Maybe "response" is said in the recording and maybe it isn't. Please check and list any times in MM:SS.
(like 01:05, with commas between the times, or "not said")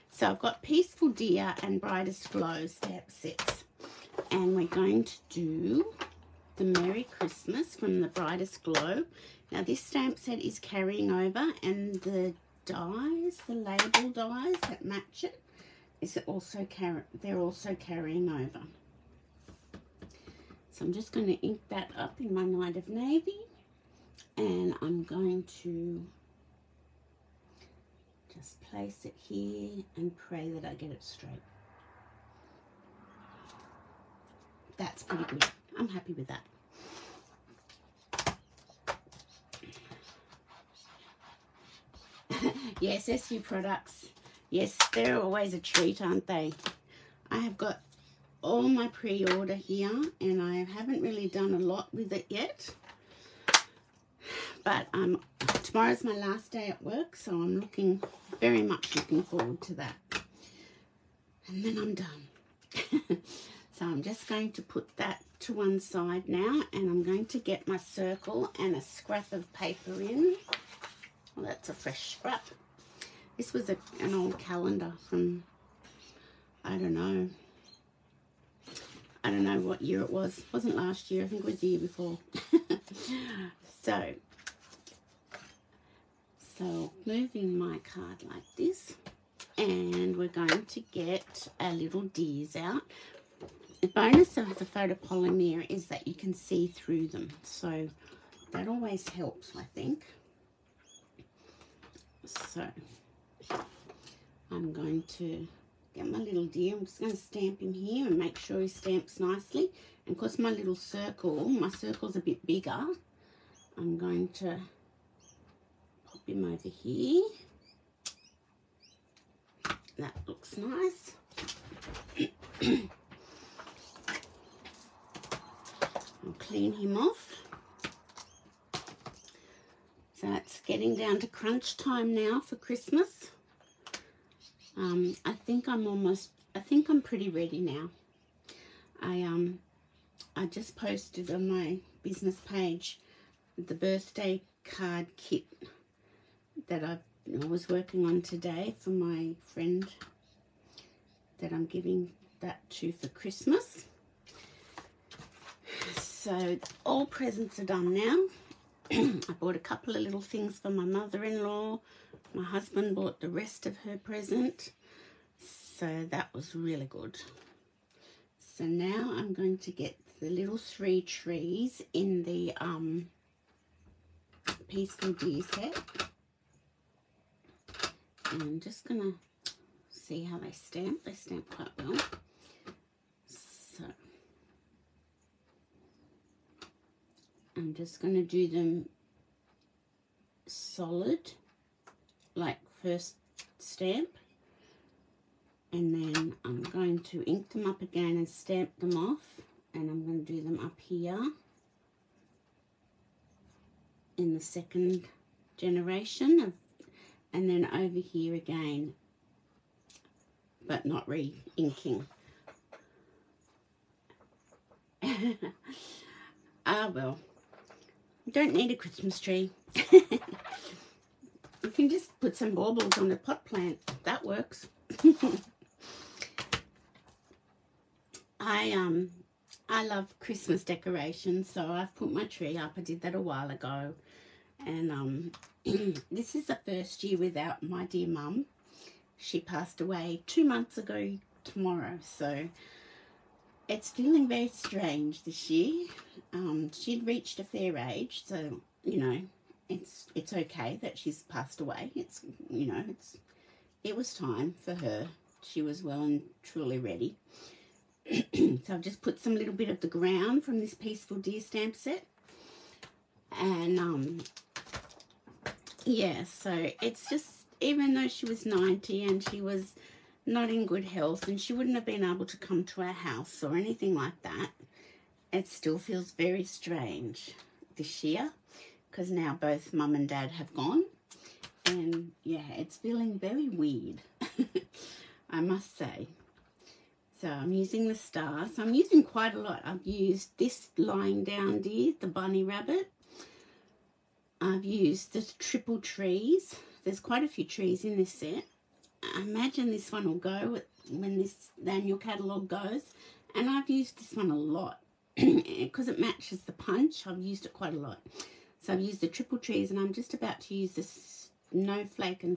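not said.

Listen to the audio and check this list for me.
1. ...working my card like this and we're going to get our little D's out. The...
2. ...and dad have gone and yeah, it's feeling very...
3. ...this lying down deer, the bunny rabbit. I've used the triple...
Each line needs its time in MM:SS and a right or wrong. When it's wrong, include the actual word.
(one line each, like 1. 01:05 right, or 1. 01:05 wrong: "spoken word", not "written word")
1. 01:27 wrong: "moving", not "working"
2. 04:39 right
3. 04:50 right.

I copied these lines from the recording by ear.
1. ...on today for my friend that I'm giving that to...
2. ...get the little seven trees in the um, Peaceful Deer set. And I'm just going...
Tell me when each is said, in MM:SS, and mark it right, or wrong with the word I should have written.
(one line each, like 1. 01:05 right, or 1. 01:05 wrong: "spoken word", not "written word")
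1. 02:28 right
2. 02:49 wrong: "three", not "seven".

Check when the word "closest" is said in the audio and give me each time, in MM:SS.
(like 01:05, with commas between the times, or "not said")
not said.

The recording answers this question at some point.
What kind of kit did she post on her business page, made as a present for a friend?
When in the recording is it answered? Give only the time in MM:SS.
02:23.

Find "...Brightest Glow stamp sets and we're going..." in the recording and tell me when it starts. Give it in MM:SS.
00:01.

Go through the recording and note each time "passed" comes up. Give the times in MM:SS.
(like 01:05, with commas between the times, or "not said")
03:59, 04:11.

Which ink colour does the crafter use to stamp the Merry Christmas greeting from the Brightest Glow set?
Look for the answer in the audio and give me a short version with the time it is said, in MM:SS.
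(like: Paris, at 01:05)
Night of Navy, at 00:22.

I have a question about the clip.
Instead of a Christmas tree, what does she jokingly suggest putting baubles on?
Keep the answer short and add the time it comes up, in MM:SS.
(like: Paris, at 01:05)
A pot plant, at 03:43.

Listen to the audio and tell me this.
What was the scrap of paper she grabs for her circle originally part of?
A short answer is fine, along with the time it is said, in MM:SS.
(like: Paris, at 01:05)
An old calendar, at 01:13.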